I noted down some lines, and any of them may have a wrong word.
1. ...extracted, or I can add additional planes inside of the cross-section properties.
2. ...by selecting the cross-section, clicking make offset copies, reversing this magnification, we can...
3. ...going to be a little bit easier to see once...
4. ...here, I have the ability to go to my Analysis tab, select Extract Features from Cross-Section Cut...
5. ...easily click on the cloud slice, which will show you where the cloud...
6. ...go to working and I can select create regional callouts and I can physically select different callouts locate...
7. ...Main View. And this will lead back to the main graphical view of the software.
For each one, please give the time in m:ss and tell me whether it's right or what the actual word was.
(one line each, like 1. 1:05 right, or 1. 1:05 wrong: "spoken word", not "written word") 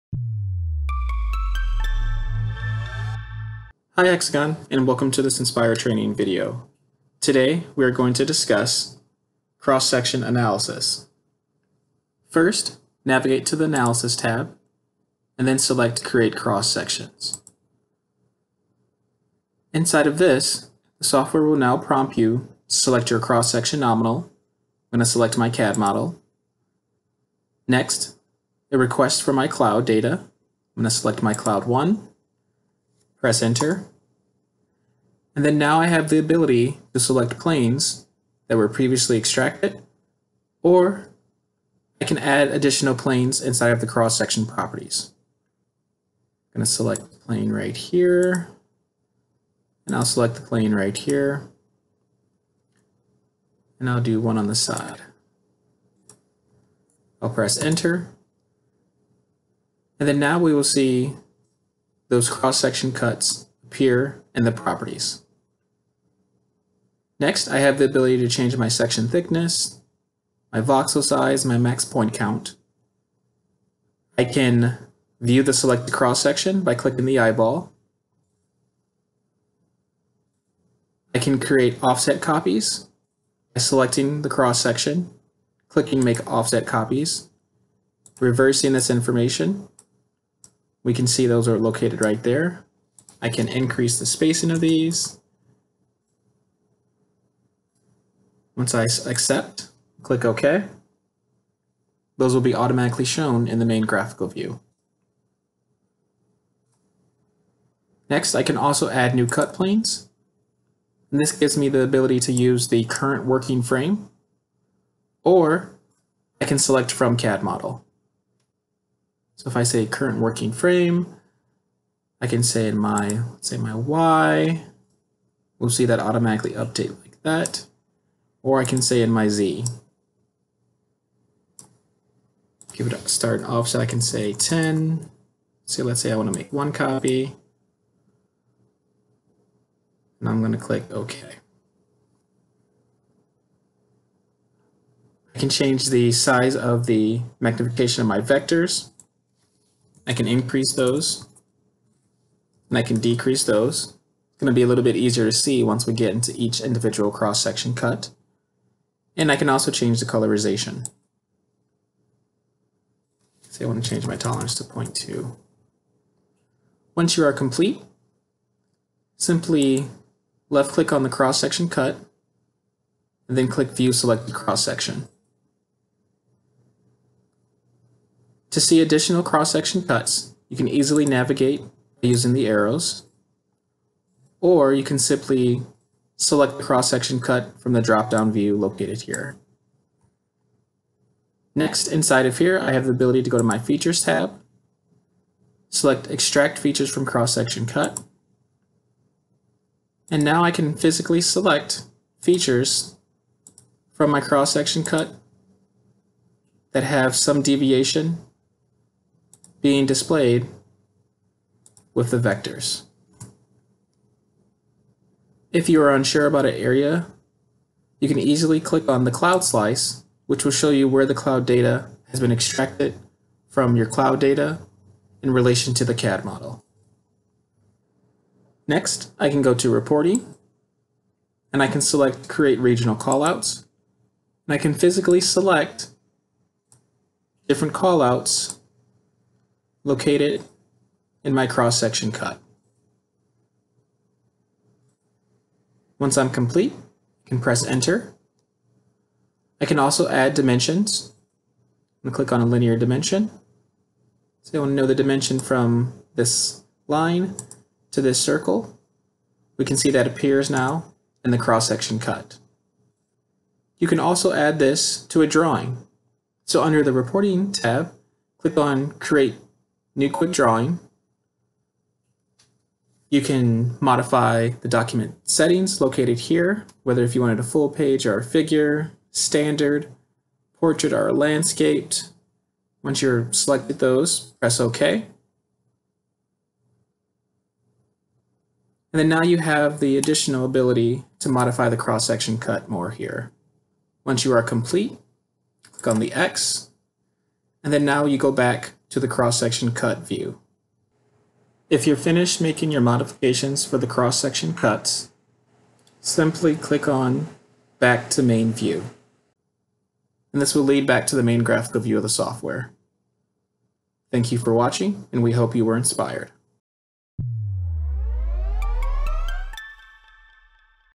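1. 0:39 right
2. 1:23 wrong: "information", not "magnification"
3. 2:34 right
4. 3:12 wrong: "Features", not "Analysis"
5. 3:38 right
6. 3:49 wrong: "reporting", not "working"
7. 5:08 right.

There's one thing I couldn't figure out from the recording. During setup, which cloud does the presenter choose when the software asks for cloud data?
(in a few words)
cloud 1.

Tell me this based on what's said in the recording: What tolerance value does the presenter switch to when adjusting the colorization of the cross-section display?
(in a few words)
0.2.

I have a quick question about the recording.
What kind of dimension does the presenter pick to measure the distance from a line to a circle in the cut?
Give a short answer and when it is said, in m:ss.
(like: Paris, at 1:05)
linear dimension, at 4:12.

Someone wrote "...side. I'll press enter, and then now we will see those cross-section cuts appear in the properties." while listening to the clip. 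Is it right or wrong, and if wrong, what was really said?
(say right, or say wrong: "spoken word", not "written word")
right.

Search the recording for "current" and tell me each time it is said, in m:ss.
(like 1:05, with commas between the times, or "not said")
1:52, 1:59.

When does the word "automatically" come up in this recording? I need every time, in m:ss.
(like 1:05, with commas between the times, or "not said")
1:42, 2:05.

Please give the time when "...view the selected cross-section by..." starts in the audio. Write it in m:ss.
1:15.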